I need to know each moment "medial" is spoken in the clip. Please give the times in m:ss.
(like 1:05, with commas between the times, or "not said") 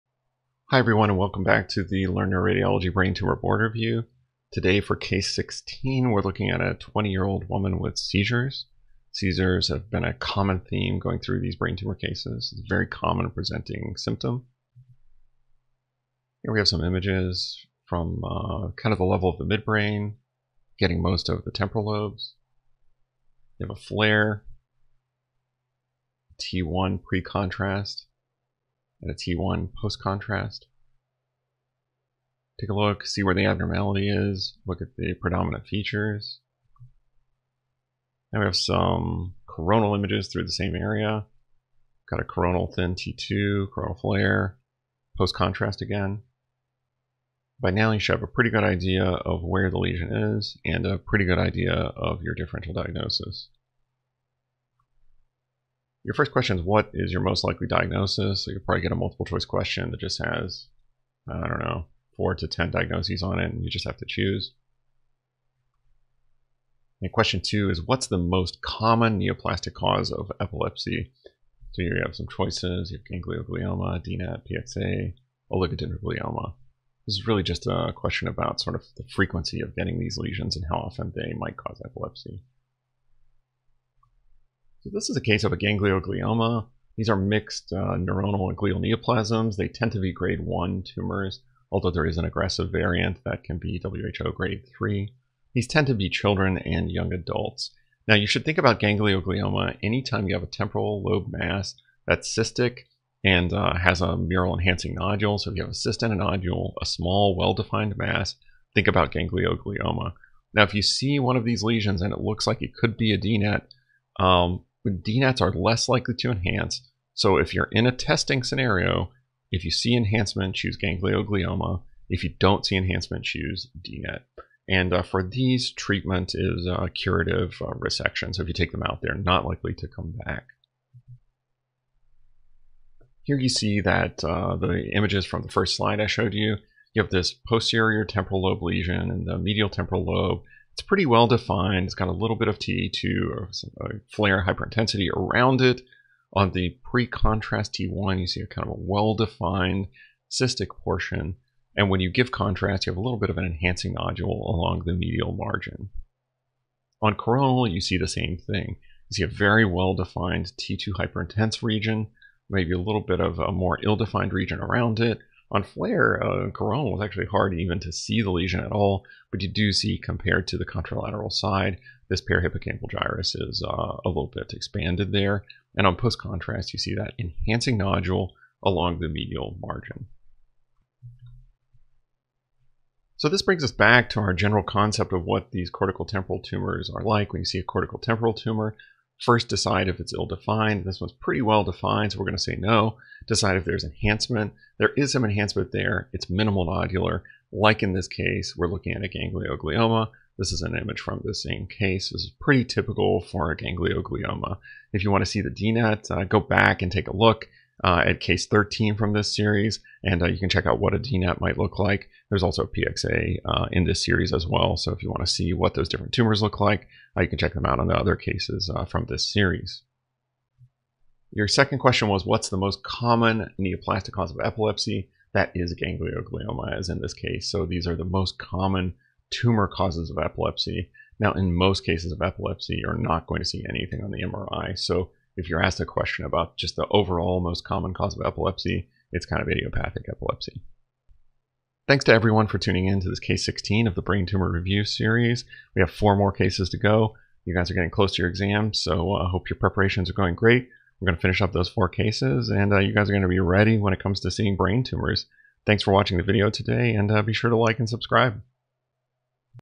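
2:19, 2:34, 2:59.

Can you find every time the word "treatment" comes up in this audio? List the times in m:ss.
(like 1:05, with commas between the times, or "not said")
2:05.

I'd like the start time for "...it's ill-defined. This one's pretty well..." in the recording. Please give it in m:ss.
3:09.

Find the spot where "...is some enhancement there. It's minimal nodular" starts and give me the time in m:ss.
3:14.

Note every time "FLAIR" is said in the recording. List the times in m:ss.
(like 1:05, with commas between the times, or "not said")
0:23, 0:43, 2:24, 2:45.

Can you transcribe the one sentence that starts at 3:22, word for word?
This is pretty typical for a ganglioglioma.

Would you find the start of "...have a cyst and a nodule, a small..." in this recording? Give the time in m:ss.
1:45.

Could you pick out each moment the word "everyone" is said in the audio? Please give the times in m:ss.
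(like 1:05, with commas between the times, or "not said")
0:00, 4:02.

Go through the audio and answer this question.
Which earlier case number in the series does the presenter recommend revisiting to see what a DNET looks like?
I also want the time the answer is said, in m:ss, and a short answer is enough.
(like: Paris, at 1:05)
13, at 3:28.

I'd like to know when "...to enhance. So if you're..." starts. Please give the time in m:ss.
1:56.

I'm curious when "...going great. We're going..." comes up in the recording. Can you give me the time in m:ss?
4:10.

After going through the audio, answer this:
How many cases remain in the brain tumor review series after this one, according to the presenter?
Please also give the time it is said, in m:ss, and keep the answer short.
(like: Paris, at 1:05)
4, at 4:05.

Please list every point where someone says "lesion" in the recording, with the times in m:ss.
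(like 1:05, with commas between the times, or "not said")
0:49, 1:20, 1:51, 2:18, 2:48.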